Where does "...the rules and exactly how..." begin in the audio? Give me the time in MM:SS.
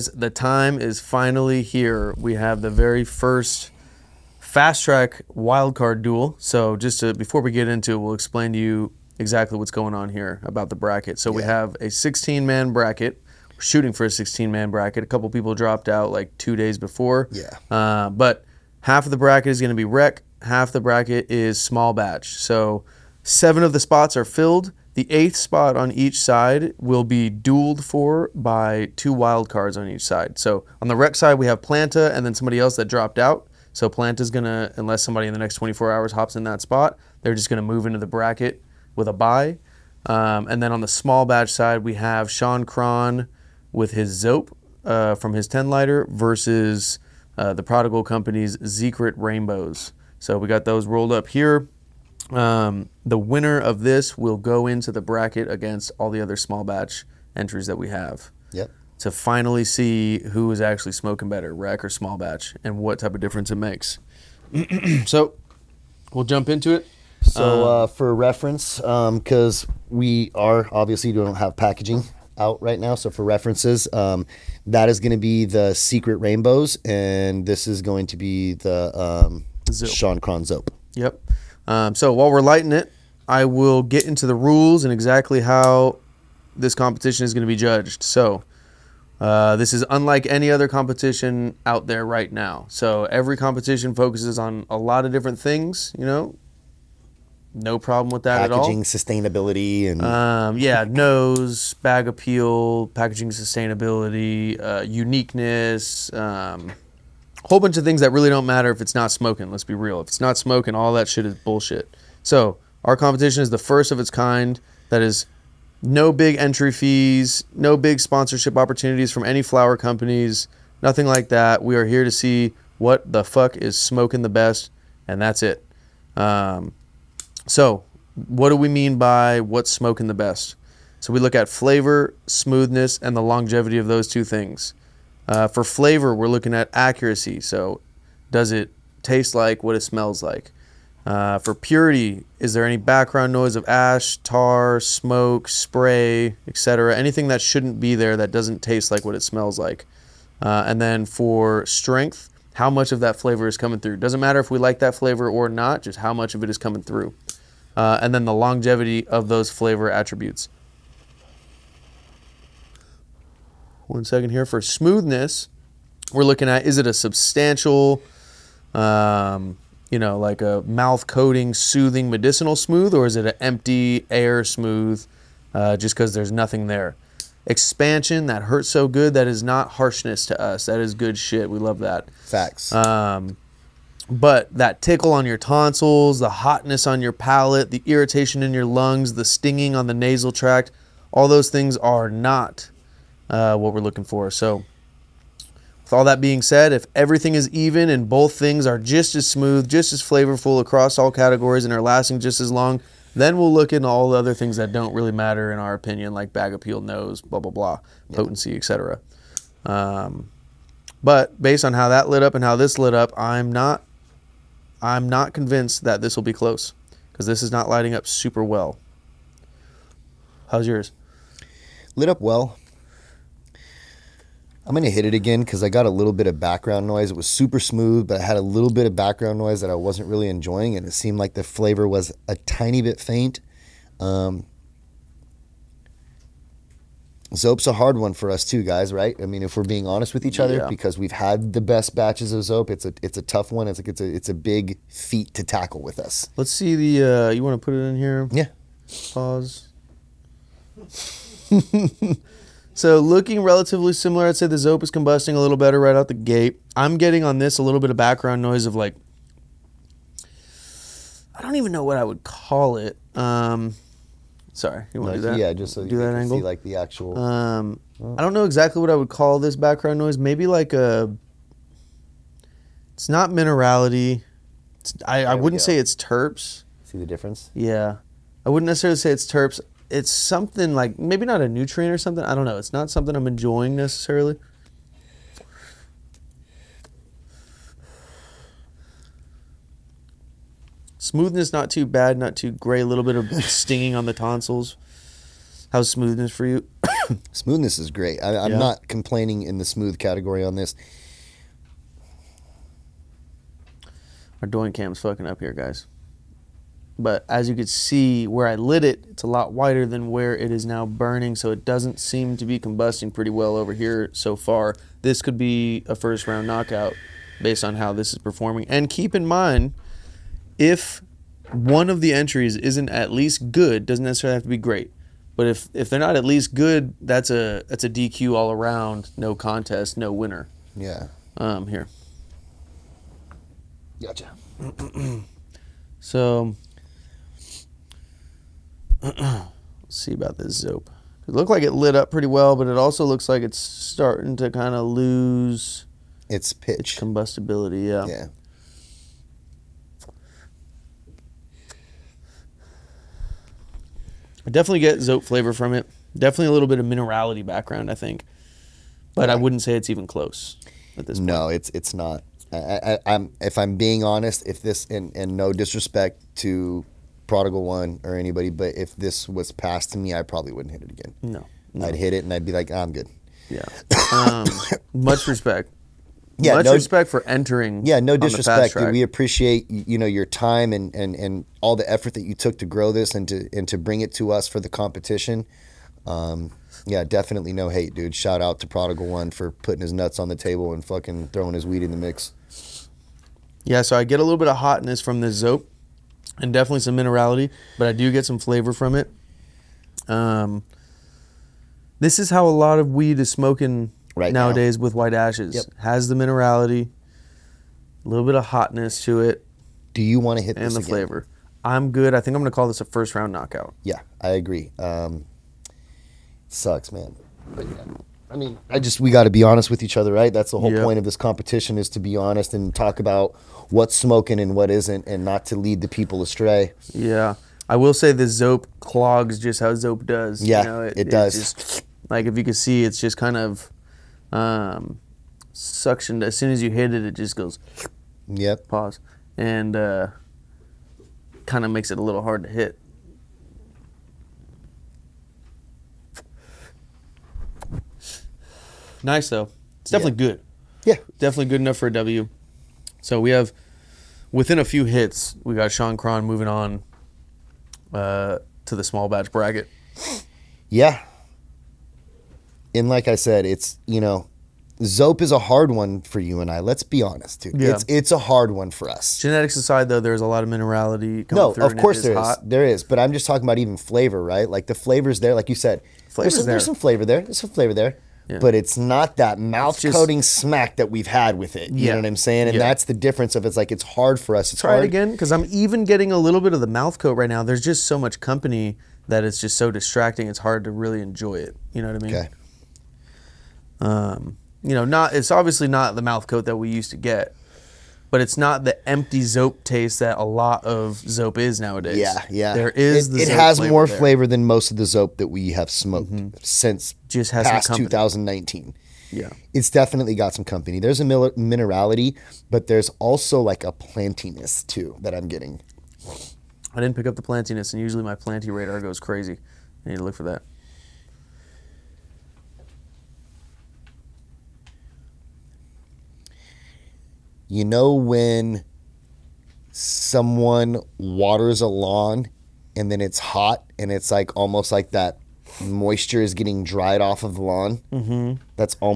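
01:24.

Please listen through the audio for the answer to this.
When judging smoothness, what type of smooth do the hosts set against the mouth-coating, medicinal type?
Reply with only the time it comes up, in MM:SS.
02:53.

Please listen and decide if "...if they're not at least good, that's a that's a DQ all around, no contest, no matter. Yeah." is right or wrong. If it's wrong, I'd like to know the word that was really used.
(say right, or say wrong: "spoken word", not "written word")
wrong: "winner", not "matter".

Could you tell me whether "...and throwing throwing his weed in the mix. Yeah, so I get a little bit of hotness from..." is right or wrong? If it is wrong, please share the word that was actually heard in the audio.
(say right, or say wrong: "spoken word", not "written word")
wrong: "fucking", not "throwing".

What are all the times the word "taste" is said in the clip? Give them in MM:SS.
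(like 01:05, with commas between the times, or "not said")
02:19, 02:28, 08:19.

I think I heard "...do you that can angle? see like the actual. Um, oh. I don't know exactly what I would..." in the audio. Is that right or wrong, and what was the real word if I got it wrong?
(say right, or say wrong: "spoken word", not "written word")
right.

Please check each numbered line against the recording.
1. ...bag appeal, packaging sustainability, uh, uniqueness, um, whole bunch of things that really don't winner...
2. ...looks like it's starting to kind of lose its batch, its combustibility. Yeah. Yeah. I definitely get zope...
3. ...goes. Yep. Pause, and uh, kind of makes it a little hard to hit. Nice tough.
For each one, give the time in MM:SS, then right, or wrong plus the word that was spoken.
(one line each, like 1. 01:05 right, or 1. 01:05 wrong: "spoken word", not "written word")
1. 01:41 wrong: "matter", not "winner"
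2. 05:43 wrong: "pitch", not "batch"
3. 07:17 wrong: "though", not "tough".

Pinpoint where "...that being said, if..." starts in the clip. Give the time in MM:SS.
03:16.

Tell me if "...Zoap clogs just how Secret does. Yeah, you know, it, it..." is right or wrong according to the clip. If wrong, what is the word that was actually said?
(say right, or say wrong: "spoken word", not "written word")
wrong: "Zoap", not "Secret".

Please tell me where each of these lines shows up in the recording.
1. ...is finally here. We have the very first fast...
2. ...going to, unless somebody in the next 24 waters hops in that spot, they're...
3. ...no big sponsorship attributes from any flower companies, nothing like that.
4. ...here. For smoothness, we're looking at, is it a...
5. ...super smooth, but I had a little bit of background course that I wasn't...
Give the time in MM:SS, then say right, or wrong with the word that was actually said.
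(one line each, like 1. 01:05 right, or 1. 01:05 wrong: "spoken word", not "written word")
1. 00:00 right
2. 00:34 wrong: "hours", not "waters"
3. 01:57 wrong: "opportunities", not "attributes"
4. 02:44 right
5. 03:47 wrong: "noise", not "course".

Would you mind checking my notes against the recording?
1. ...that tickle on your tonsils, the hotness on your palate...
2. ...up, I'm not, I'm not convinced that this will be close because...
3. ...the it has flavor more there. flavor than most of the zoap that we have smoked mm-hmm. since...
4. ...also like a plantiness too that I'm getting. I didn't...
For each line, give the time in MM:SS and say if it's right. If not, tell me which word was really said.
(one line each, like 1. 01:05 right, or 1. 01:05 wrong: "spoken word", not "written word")
1. 03:04 right
2. 03:32 right
3. 08:23 right
4. 08:32 right.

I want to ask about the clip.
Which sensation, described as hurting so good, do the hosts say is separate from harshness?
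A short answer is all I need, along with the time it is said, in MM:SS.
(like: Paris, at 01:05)
Expansion, at 02:57.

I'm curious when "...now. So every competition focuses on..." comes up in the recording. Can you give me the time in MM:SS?
01:32.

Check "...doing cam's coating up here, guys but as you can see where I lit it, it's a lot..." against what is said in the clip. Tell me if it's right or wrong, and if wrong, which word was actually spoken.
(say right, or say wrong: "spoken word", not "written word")
wrong: "fucking", not "coating".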